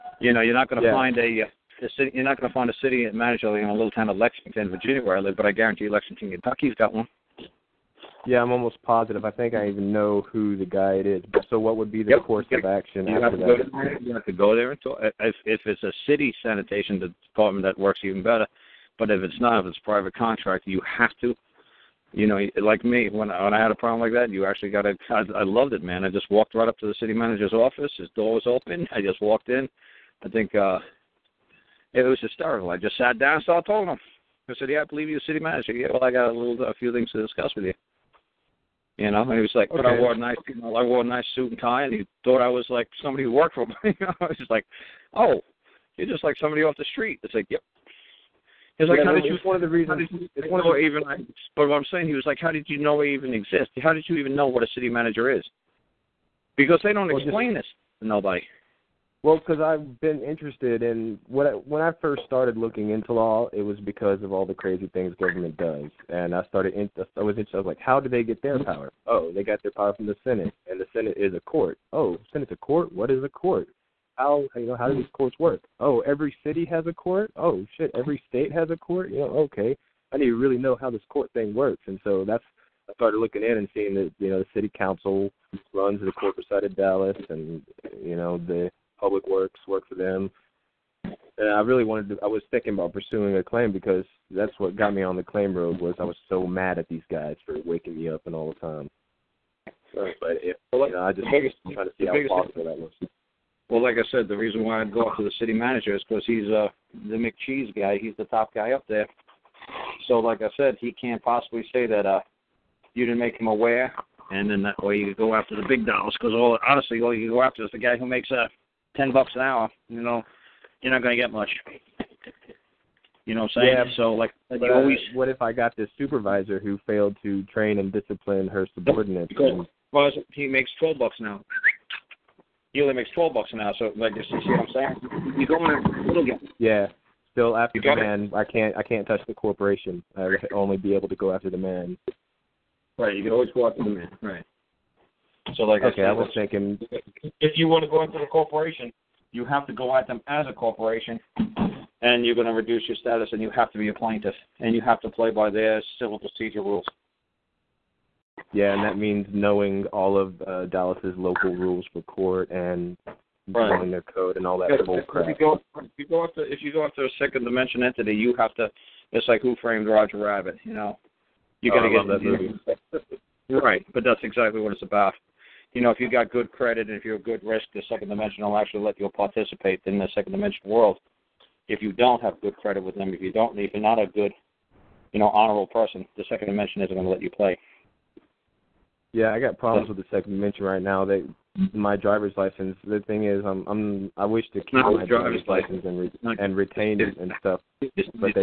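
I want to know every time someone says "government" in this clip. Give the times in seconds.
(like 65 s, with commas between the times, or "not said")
65 s.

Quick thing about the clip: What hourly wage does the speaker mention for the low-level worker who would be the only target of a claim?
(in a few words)
$10 an hour.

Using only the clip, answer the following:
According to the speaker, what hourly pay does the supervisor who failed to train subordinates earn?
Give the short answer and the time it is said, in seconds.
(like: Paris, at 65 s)
$12 an hour, at 133 s.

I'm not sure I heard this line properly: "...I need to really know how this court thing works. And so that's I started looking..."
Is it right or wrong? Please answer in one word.
right.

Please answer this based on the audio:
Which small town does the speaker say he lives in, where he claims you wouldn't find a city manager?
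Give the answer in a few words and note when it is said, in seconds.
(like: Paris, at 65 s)
Lexington, Virginia, at 4 s.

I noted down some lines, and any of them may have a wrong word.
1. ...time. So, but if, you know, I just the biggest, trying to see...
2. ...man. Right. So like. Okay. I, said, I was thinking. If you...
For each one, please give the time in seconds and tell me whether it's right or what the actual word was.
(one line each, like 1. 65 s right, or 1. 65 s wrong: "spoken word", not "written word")
1. 98 s right
2. 143 s right.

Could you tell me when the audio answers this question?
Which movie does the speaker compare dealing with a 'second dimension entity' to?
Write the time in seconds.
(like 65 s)
169 s.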